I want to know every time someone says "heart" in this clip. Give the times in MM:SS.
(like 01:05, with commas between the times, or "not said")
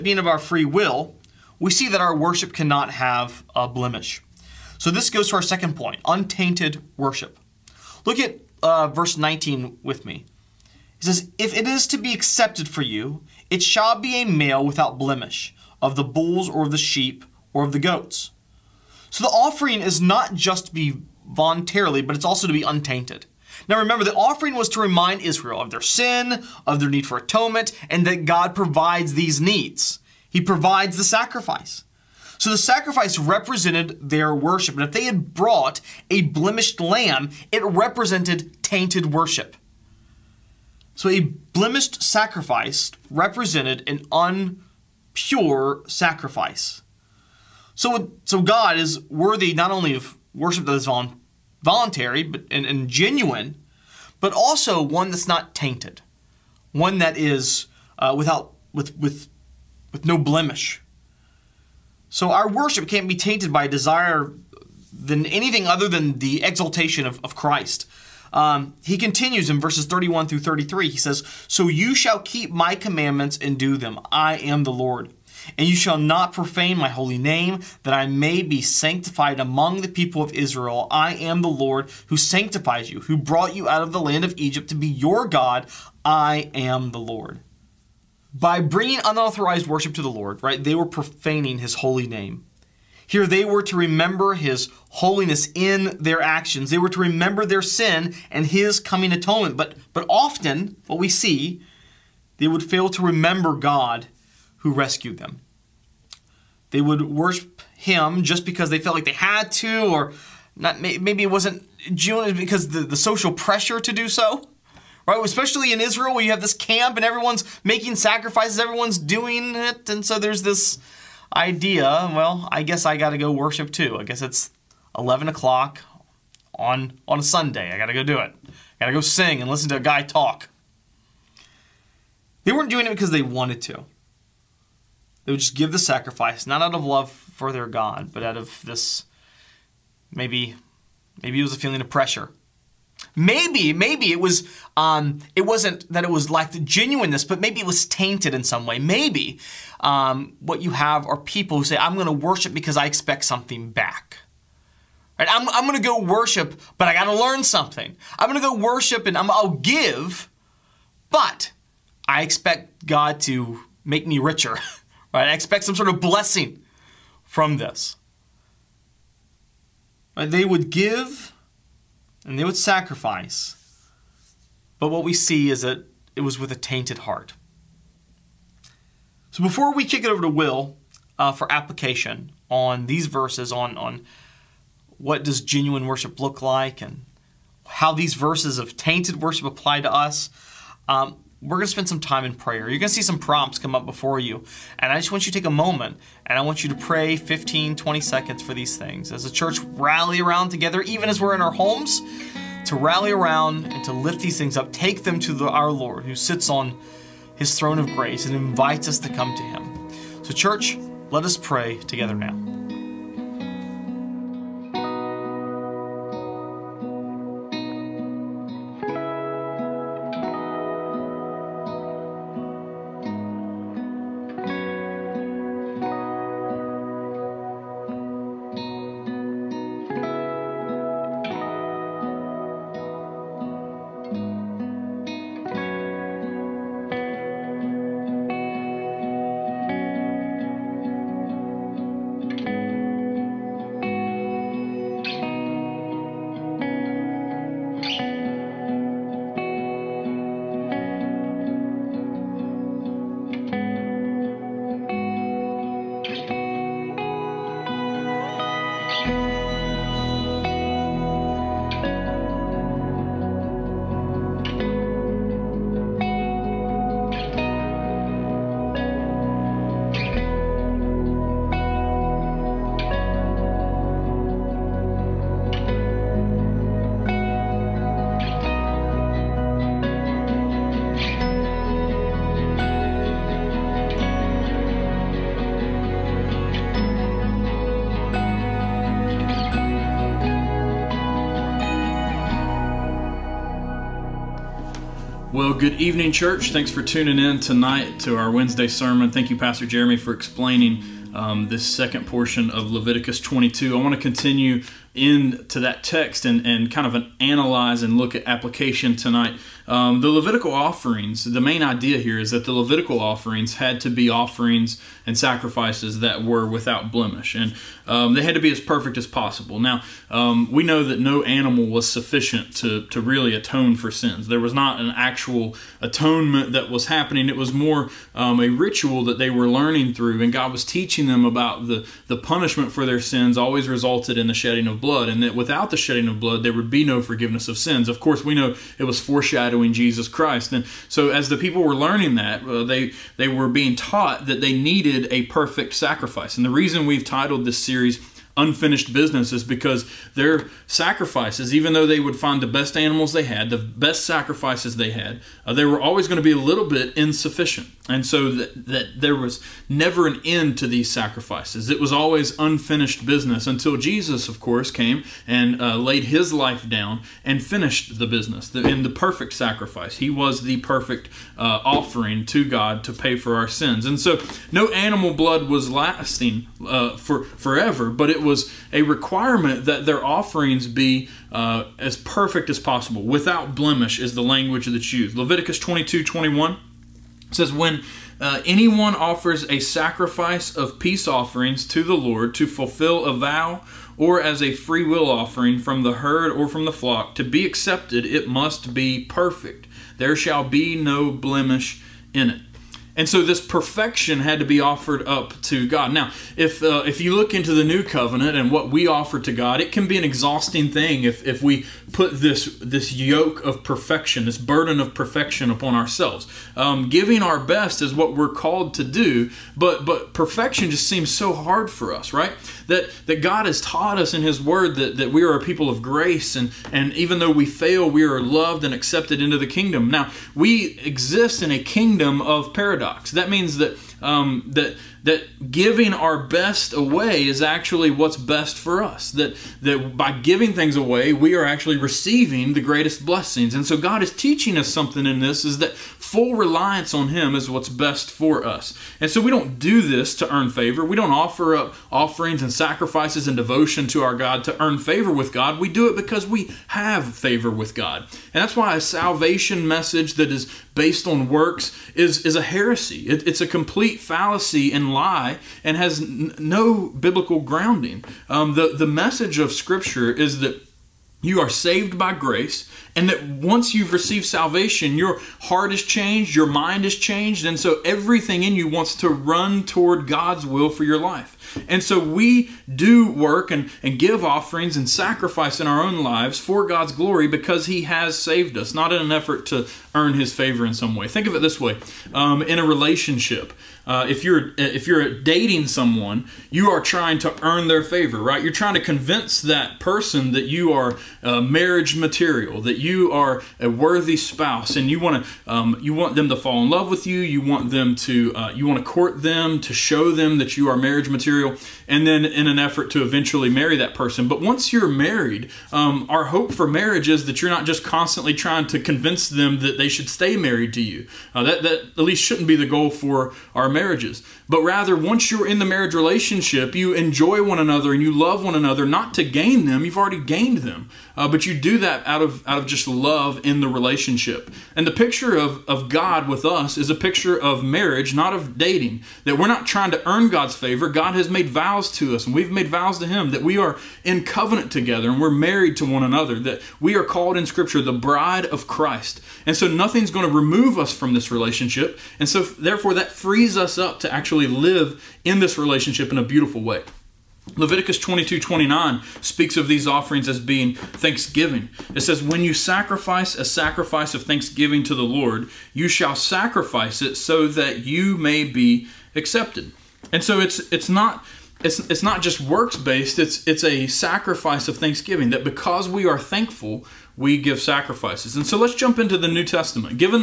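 02:56, 07:55.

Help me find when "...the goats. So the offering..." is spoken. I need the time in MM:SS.
00:17.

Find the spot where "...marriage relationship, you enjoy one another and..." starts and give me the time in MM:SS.
08:45.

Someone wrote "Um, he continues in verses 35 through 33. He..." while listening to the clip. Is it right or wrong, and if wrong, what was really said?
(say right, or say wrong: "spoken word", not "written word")
wrong: "31", not "35".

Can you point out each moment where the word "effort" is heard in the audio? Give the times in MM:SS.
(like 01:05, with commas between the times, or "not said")
08:09, 08:32.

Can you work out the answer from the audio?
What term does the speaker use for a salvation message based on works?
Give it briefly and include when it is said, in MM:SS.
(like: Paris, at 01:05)
Heresy, at 07:42.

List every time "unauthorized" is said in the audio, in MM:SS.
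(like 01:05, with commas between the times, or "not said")
01:29.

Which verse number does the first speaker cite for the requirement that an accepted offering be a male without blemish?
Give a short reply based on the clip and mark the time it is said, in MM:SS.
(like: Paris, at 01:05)
19, at 00:08.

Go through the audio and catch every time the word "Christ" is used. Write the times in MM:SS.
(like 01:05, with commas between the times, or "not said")
01:07, 05:40, 09:08.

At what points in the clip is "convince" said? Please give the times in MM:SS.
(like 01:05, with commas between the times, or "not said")
08:18, 08:38.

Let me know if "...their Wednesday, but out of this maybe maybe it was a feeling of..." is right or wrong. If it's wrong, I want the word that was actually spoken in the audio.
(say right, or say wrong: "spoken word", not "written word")
wrong: "God", not "Wednesday".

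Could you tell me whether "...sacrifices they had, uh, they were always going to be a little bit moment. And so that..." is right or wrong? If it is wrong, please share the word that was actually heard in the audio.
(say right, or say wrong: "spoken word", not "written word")
wrong: "insufficient", not "moment".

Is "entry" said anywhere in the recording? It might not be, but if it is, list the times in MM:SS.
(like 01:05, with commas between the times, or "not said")
not said.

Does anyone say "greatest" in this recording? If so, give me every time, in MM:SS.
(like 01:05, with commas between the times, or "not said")
07:22.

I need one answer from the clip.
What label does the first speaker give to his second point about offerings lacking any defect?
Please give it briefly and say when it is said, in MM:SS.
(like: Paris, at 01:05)
Untainted worship, at 00:06.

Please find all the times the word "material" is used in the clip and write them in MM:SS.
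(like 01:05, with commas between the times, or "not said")
08:21, 08:31.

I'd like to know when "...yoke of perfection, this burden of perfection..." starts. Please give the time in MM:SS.
06:52.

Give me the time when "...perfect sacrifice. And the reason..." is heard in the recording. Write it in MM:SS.
05:45.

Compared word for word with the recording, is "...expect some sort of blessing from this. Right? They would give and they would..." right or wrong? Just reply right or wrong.
right.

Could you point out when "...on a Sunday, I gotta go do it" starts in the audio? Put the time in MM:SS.
02:07.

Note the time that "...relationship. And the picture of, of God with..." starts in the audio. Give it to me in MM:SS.
08:53.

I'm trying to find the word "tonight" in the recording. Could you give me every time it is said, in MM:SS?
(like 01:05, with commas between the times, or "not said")
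04:57, 05:08.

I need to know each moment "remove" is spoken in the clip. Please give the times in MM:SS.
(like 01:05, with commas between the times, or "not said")
09:10.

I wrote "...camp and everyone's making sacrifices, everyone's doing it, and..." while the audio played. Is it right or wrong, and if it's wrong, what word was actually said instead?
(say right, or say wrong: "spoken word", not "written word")
right.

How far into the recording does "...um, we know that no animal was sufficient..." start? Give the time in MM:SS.
05:20.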